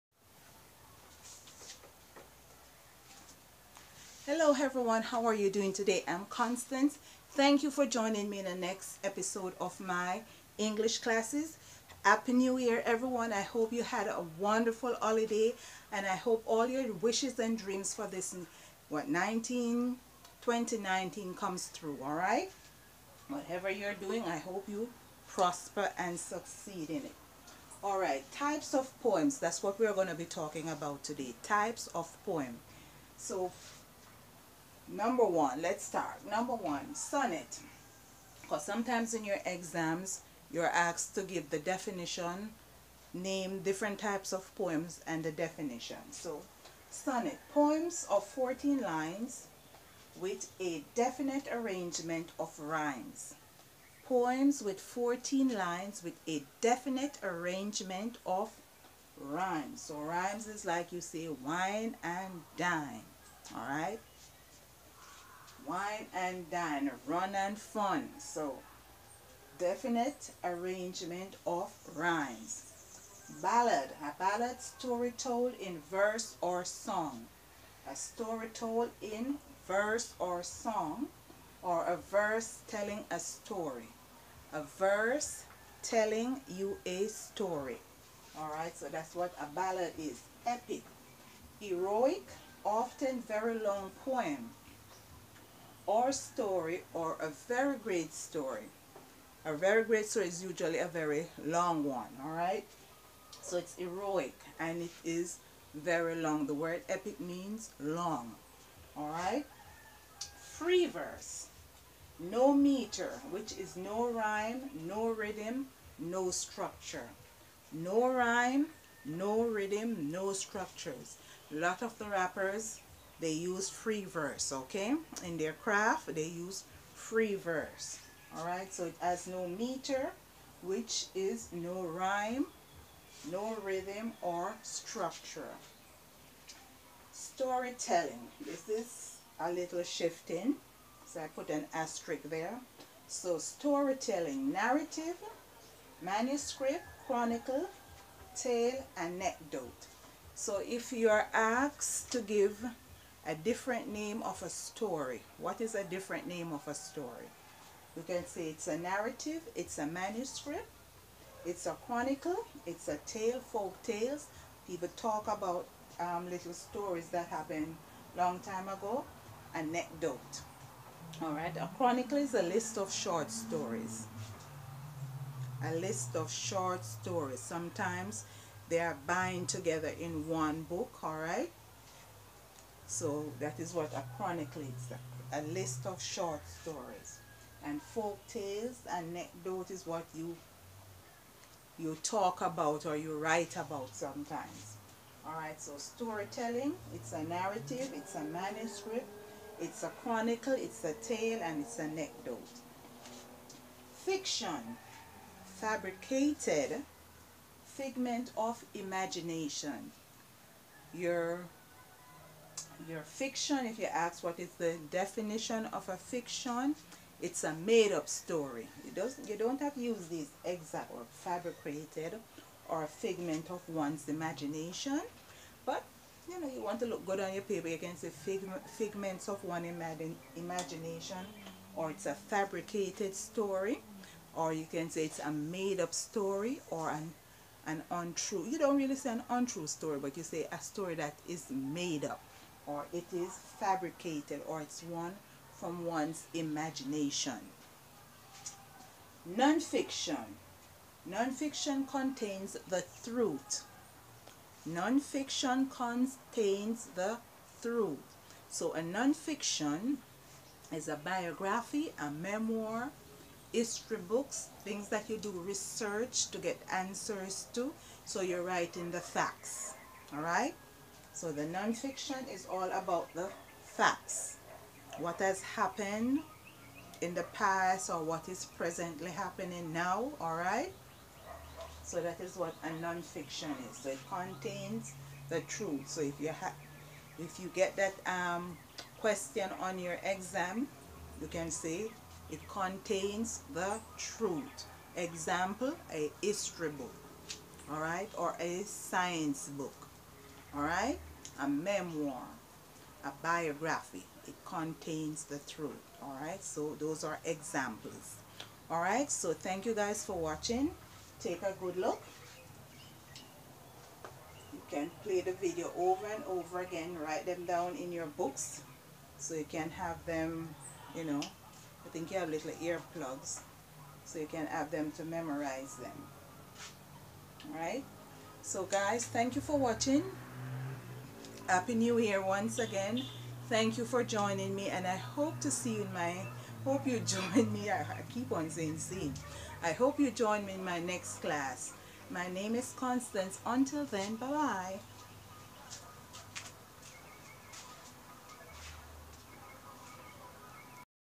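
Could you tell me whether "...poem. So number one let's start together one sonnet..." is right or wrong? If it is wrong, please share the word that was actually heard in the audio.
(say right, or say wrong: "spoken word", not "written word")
wrong: "number", not "together".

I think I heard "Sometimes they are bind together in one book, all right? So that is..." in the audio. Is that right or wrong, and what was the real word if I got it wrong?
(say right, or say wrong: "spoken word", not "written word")
right.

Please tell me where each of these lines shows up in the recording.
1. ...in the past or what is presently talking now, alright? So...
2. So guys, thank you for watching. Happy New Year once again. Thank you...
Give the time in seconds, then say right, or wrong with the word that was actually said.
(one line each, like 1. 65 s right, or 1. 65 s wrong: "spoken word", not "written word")
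1. 277 s wrong: "happening", not "talking"
2. 328 s right.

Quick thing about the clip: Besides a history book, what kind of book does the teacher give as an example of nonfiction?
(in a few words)
A science book.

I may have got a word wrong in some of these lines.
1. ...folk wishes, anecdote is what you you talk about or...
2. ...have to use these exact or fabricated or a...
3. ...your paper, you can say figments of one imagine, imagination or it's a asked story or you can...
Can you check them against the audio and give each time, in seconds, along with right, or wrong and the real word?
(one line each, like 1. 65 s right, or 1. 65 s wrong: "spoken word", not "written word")
1. 187 s wrong: "tales", not "wishes"
2. 219 s right
3. 227 s wrong: "fabricated", not "asked".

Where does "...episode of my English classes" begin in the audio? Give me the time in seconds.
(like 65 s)
9 s.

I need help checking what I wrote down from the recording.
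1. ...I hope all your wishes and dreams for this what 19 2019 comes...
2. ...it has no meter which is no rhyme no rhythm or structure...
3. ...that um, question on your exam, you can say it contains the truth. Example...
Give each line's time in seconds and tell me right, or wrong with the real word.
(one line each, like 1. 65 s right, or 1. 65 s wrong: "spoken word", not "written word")
1. 16 s right
2. 128 s right
3. 287 s right.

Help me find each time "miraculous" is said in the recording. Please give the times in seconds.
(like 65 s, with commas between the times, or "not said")
not said.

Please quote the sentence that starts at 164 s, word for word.
People talk about um, little stories that happened long time ago, anecdote.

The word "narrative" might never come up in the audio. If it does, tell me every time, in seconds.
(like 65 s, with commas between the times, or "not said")
144 s, 158 s, 197 s.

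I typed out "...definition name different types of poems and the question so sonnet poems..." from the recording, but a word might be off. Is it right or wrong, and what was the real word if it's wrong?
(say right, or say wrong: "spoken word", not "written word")
wrong: "definition", not "question".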